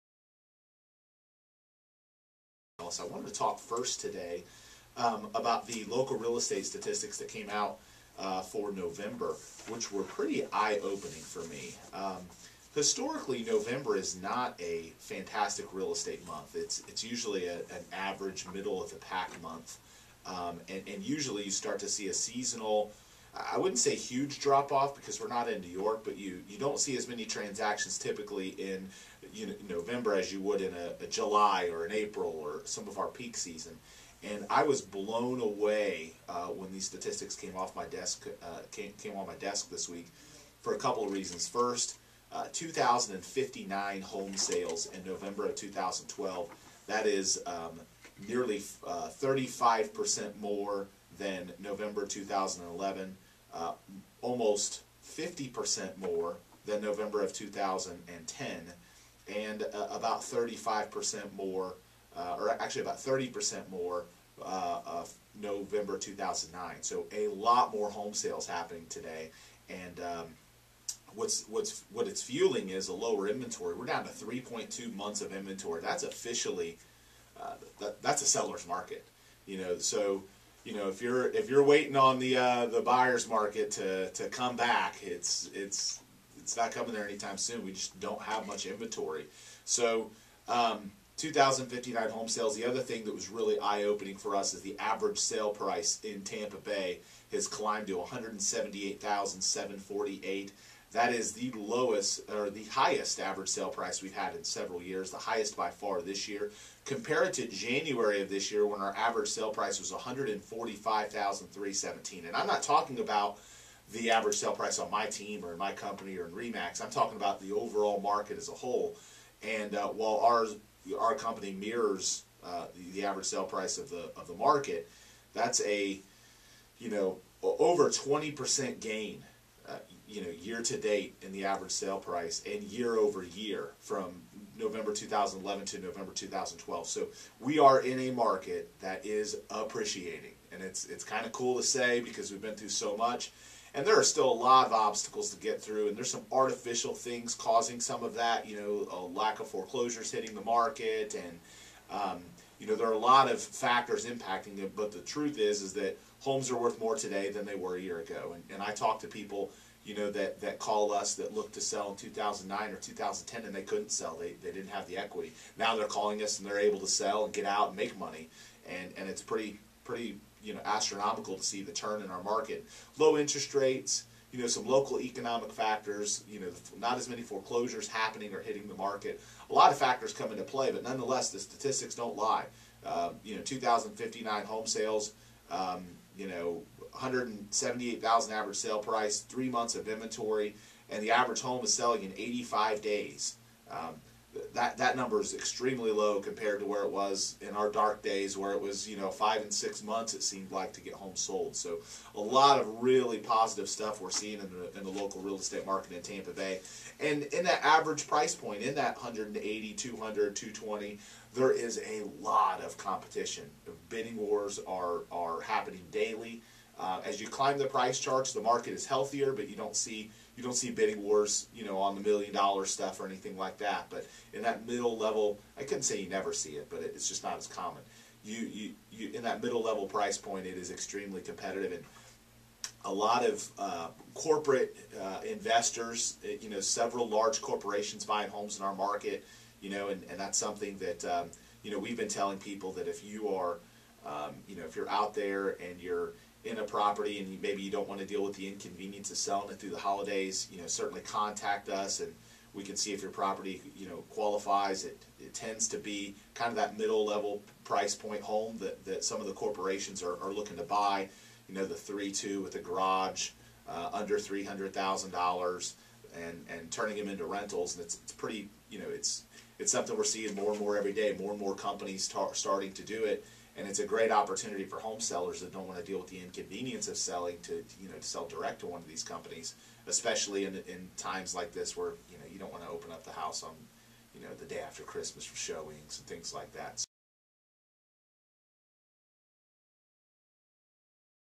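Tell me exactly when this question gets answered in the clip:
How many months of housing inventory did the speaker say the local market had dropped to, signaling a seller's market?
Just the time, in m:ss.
1:14.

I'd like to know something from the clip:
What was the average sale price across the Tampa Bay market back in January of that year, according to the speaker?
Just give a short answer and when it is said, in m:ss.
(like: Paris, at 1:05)
$145,317, at 1:49.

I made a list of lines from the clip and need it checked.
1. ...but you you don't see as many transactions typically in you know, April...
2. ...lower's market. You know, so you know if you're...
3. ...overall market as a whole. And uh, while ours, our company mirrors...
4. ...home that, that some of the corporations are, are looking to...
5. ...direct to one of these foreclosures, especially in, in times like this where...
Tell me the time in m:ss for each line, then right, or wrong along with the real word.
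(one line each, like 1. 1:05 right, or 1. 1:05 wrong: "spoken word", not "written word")
1. 0:26 wrong: "November", not "April"
2. 1:18 wrong: "seller", not "lower"
3. 1:57 right
4. 4:18 right
5. 4:38 wrong: "companies", not "foreclosures".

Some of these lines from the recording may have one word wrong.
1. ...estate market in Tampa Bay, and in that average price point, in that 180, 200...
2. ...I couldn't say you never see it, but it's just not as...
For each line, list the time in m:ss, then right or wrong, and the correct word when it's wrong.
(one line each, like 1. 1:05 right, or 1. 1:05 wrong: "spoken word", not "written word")
1. 3:25 right
2. 3:45 right.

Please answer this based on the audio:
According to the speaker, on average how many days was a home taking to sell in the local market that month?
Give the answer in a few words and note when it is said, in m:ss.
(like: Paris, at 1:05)
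85 days, at 3:12.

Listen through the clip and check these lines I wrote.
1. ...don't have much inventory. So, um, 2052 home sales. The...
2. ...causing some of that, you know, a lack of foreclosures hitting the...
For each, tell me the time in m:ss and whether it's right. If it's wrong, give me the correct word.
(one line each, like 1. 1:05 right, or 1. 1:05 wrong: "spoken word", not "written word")
1. 1:28 wrong: "2059", not "2052"
2. 2:27 right.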